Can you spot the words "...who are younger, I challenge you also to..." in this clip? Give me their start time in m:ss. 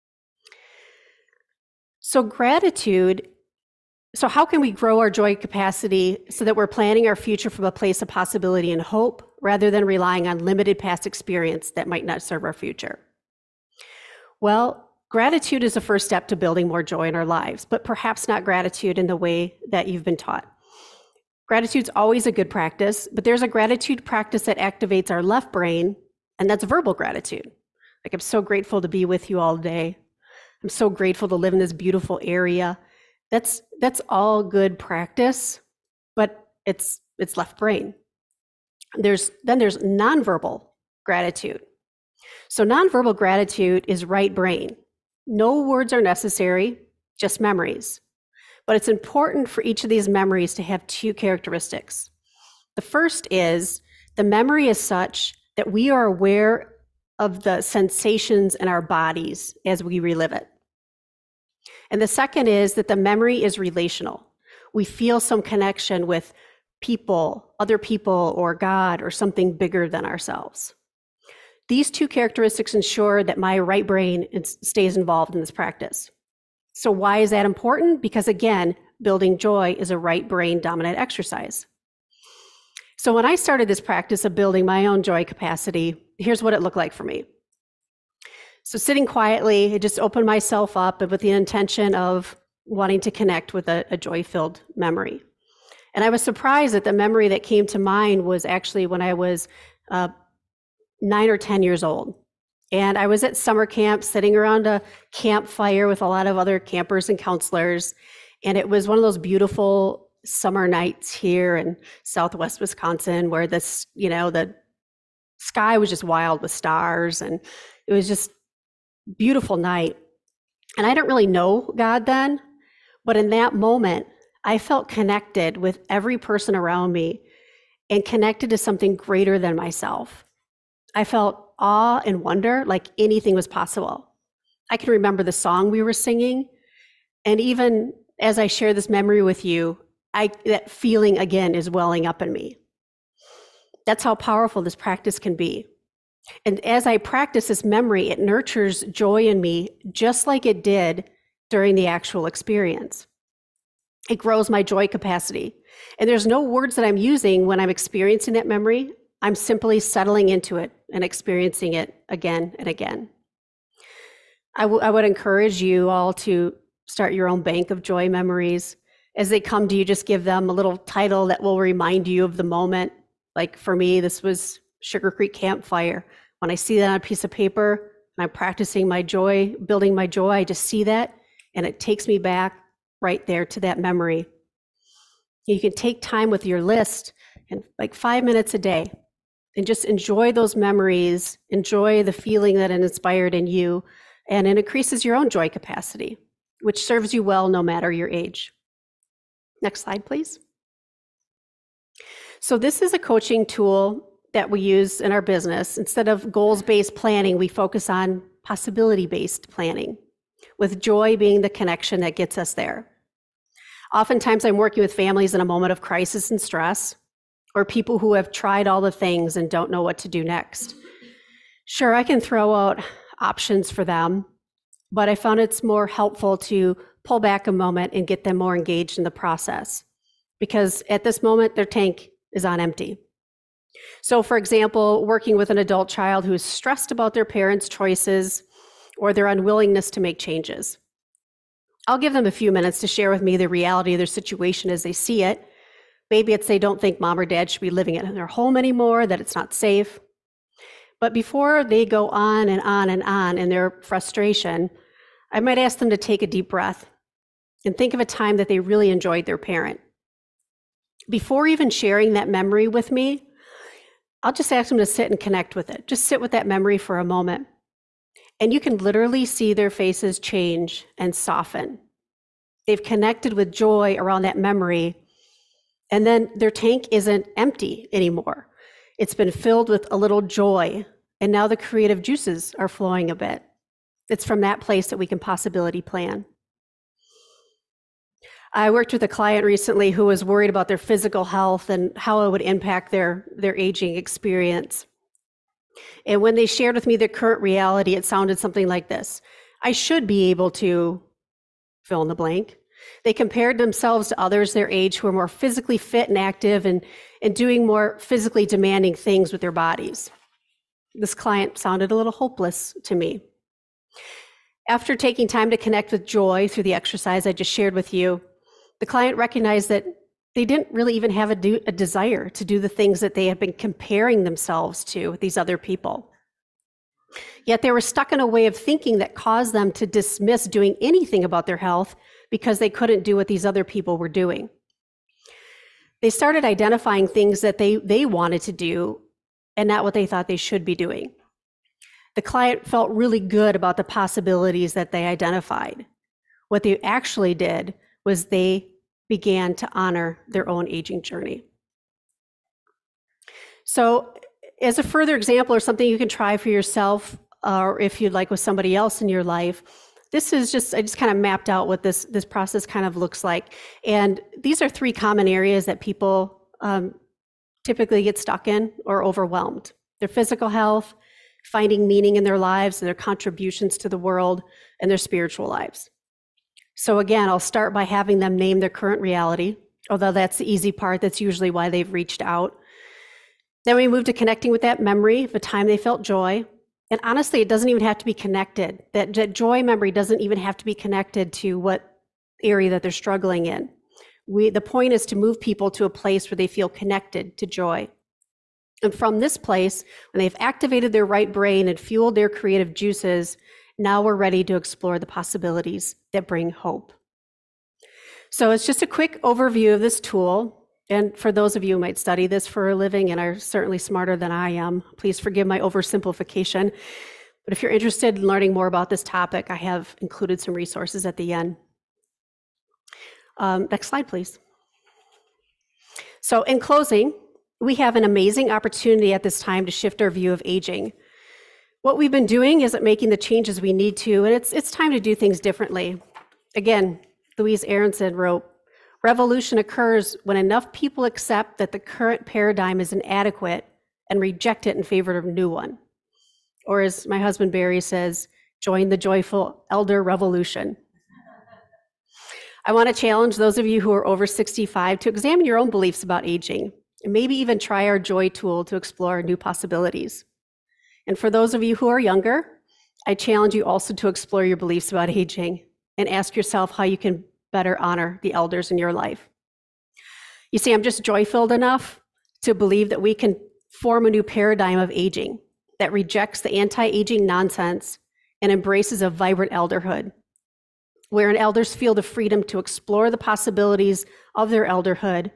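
7:41.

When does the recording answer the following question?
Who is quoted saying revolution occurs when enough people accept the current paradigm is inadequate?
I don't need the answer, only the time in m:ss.
7:17.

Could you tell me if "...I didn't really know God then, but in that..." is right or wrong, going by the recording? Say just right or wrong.
right.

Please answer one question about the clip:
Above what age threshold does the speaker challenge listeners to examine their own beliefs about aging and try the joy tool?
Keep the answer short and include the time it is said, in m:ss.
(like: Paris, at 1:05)
65, at 7:34.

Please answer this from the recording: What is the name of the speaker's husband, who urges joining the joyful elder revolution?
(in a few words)
Barry.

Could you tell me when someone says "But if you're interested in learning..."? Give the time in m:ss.
6:57.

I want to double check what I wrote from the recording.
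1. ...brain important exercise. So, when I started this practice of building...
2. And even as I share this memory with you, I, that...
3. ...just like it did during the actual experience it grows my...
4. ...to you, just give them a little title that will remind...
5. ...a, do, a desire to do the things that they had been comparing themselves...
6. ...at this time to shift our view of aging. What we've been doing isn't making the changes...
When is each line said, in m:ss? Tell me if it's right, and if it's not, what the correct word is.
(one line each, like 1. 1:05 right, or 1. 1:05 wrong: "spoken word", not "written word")
1. 1:20 wrong: "dominant", not "important"
2. 2:17 right
3. 2:29 right
4. 2:49 right
5. 5:21 right
6. 7:09 right.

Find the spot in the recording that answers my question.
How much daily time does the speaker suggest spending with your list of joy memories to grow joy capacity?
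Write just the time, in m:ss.
3:07.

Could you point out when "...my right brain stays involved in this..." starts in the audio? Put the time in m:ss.
1:13.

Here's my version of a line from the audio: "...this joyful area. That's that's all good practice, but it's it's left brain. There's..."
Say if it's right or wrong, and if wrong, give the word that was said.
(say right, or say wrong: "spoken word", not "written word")
wrong: "beautiful", not "joyful".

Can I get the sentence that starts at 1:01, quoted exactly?
And the second is that the memory is relational.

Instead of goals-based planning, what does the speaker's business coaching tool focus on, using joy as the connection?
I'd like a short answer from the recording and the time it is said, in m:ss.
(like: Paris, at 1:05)
Possibility based planning, at 3:28.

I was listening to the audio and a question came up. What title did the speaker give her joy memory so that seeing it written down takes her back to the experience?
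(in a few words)
Sugar Creek Campfire.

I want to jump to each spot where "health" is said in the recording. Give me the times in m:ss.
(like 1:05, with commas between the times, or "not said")
4:51, 5:31, 6:10.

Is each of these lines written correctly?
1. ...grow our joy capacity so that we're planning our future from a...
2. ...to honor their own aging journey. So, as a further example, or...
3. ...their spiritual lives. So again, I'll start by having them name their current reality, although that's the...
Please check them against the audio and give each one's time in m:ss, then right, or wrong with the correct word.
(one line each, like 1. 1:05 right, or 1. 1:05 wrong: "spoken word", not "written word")
1. 0:04 right
2. 5:49 right
3. 6:14 right.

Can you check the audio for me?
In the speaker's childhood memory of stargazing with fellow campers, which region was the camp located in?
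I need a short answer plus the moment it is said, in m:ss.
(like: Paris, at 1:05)
Southwest Wisconsin, at 1:52.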